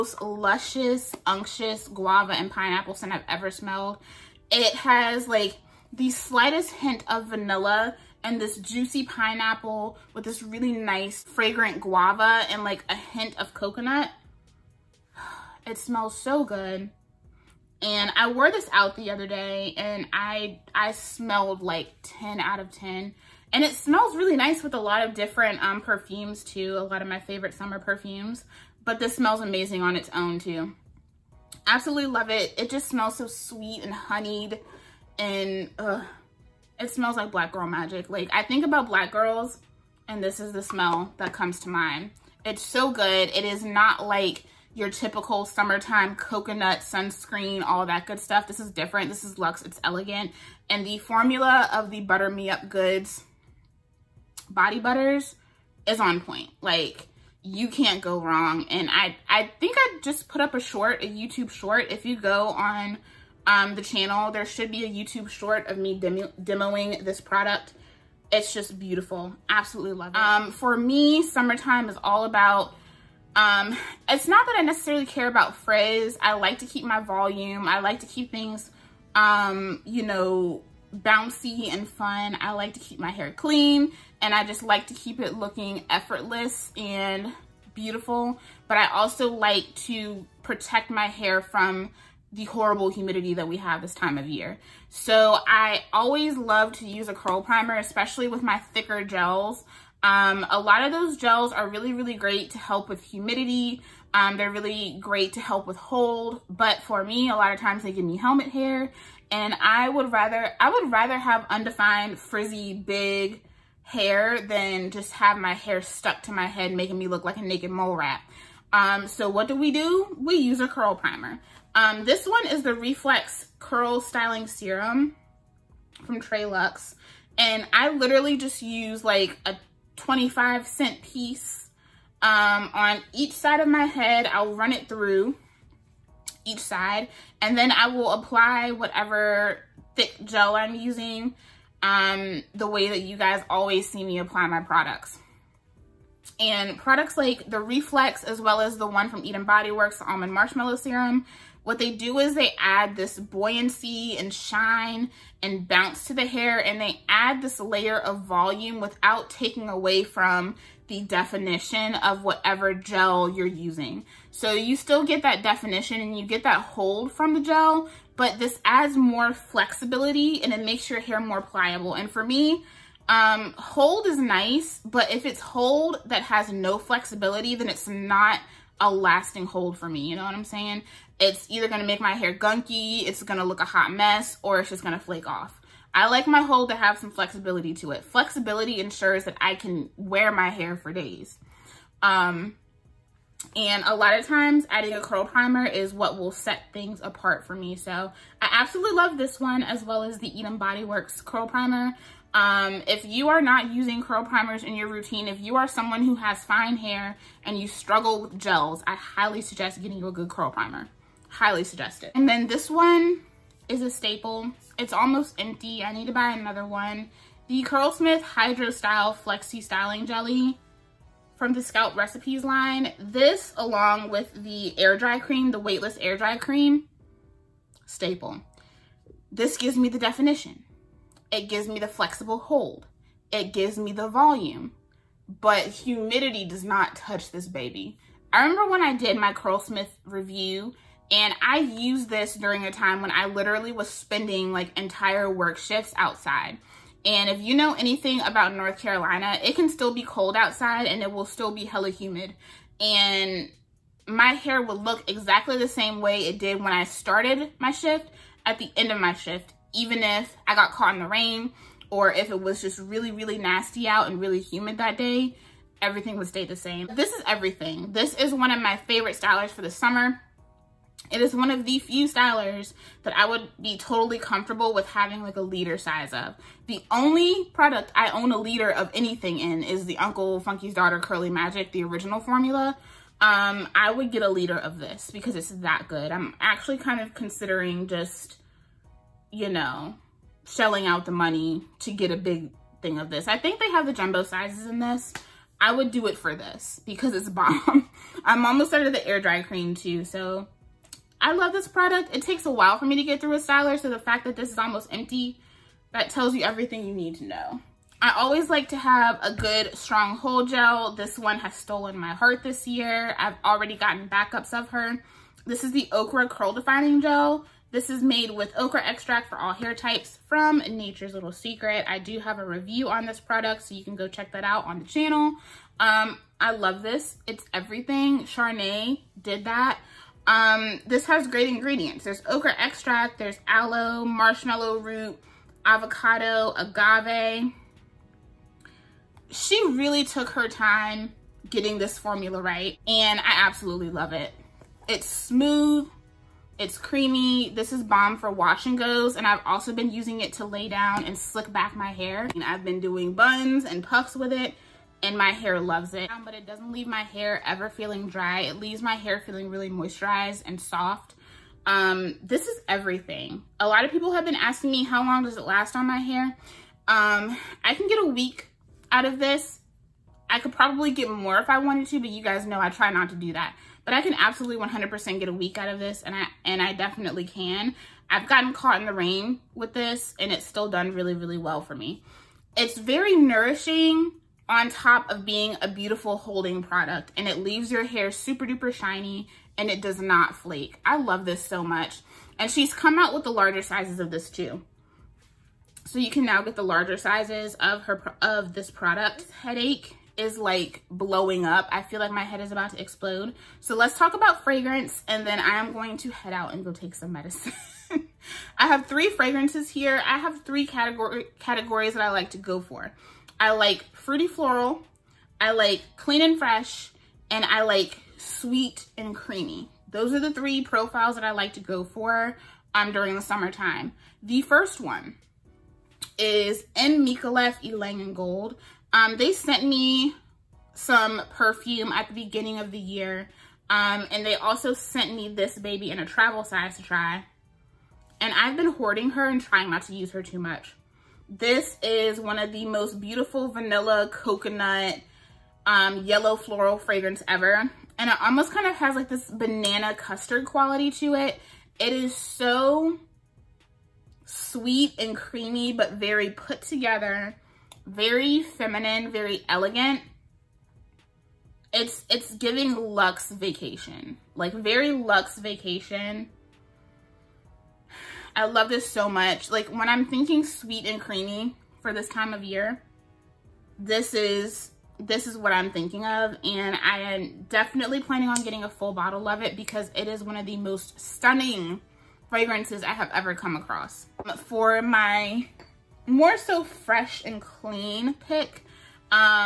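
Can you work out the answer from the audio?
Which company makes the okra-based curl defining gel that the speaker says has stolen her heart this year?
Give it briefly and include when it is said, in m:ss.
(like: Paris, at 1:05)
Nature's Little Secret, at 5:20.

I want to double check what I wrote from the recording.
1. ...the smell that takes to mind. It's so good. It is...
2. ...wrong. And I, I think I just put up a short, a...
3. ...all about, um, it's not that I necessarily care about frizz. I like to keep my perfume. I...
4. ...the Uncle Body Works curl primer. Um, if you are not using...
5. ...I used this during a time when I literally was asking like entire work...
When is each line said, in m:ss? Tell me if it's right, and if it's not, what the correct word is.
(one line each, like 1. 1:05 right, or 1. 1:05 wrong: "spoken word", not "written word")
1. 0:40 wrong: "comes", not "takes"
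2. 0:58 right
3. 1:12 wrong: "volume", not "perfume"
4. 3:20 wrong: "Eden", not "Uncle"
5. 4:01 wrong: "spending", not "asking".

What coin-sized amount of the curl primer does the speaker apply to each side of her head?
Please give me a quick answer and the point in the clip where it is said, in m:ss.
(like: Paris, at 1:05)
25 cent piece, at 2:09.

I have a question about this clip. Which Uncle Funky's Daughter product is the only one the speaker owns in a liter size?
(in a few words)
Curly Magic.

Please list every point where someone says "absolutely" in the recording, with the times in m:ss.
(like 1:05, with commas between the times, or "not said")
0:31, 1:09, 3:18, 5:43, 6:14.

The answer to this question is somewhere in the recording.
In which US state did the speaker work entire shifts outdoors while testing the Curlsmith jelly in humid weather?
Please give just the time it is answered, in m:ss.
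4:08.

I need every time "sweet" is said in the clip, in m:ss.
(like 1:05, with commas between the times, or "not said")
0:33, 6:58, 7:34, 7:50.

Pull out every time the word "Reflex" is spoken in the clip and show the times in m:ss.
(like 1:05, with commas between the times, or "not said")
2:02, 2:27.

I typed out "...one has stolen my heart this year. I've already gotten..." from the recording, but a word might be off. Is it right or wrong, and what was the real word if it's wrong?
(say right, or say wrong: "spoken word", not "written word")
right.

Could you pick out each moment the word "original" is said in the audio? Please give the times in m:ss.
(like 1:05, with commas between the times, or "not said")
4:41.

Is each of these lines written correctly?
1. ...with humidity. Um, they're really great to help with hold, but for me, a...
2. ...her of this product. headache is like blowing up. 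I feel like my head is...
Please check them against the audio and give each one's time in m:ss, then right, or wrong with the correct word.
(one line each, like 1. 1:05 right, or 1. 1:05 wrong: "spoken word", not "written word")
1. 1:42 right
2. 6:37 right.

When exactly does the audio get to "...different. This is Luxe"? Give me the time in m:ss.
0:48.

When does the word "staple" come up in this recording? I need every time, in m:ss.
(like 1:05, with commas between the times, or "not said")
3:33, 3:47.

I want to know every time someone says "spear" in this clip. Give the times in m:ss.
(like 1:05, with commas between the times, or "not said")
not said.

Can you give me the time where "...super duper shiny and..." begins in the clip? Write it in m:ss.
6:28.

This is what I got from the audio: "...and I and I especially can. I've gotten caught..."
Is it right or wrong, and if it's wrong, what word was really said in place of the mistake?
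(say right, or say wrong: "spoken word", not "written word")
wrong: "definitely", not "especially".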